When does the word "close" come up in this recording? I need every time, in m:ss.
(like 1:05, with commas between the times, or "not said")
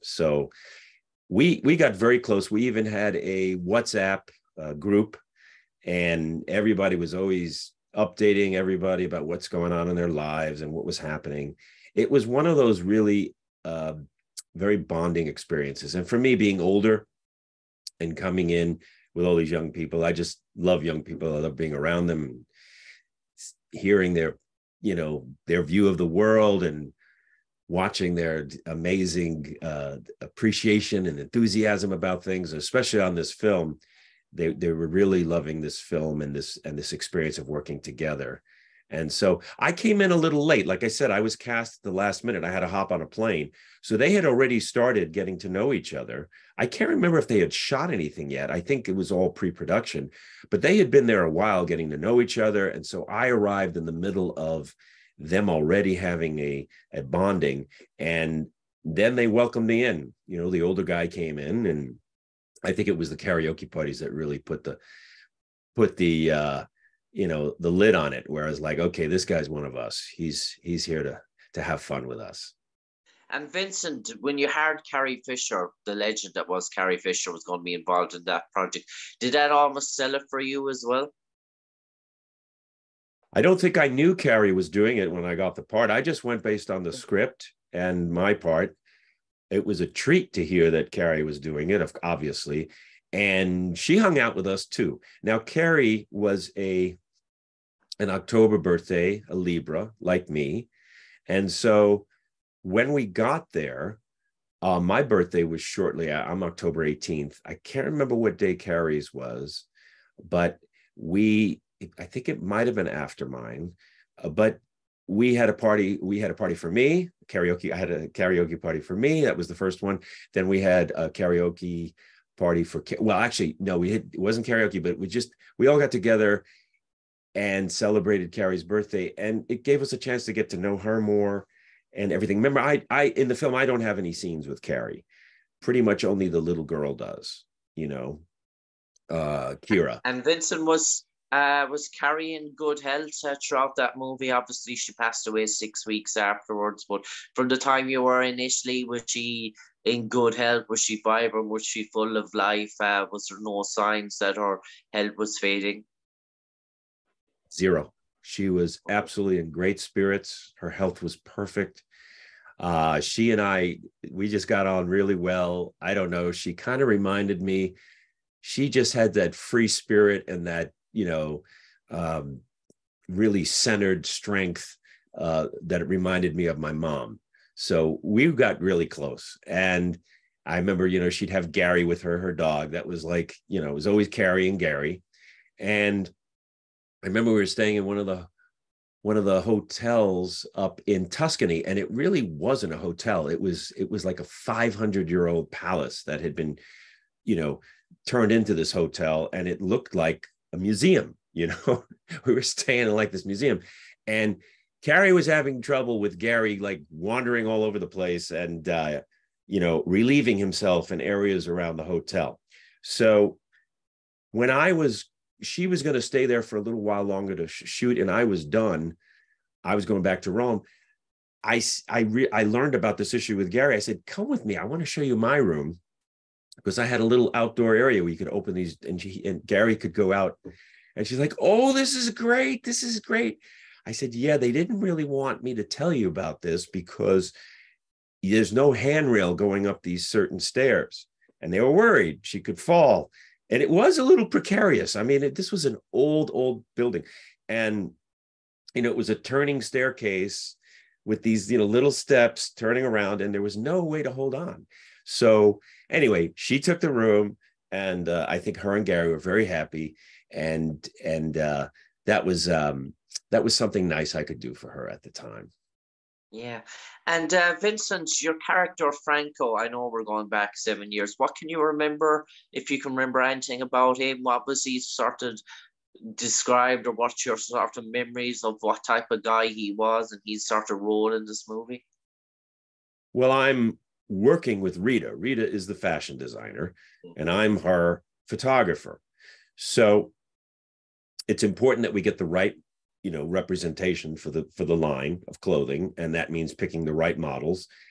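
0:02, 2:58.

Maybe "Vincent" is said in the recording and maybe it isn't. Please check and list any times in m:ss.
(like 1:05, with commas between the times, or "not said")
1:13, 2:20, 4:27.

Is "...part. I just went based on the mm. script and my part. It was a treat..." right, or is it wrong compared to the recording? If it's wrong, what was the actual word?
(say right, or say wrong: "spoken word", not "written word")
right.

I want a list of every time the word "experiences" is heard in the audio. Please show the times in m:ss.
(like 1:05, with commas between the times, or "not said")
0:15, 0:36.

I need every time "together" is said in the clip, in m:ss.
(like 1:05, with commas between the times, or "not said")
0:37, 2:05.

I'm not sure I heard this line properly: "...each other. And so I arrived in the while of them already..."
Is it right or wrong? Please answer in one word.
wrong.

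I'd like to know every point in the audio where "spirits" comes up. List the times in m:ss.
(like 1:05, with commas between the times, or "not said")
2:39, 2:49.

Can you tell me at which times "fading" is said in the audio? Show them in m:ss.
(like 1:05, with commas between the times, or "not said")
2:35.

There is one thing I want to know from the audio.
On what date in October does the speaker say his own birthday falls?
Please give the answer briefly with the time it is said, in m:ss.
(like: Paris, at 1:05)
October 18th, at 1:46.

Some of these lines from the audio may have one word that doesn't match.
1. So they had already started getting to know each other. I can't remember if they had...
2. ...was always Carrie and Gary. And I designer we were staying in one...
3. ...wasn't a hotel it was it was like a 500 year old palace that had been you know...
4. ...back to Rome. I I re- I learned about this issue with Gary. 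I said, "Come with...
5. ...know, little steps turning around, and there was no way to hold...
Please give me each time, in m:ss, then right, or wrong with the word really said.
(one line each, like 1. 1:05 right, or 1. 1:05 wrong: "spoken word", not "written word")
1. 0:43 right
2. 3:03 wrong: "remember", not "designer"
3. 3:12 right
4. 3:40 right
5. 4:11 right.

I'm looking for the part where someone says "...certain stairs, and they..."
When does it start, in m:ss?
4:00.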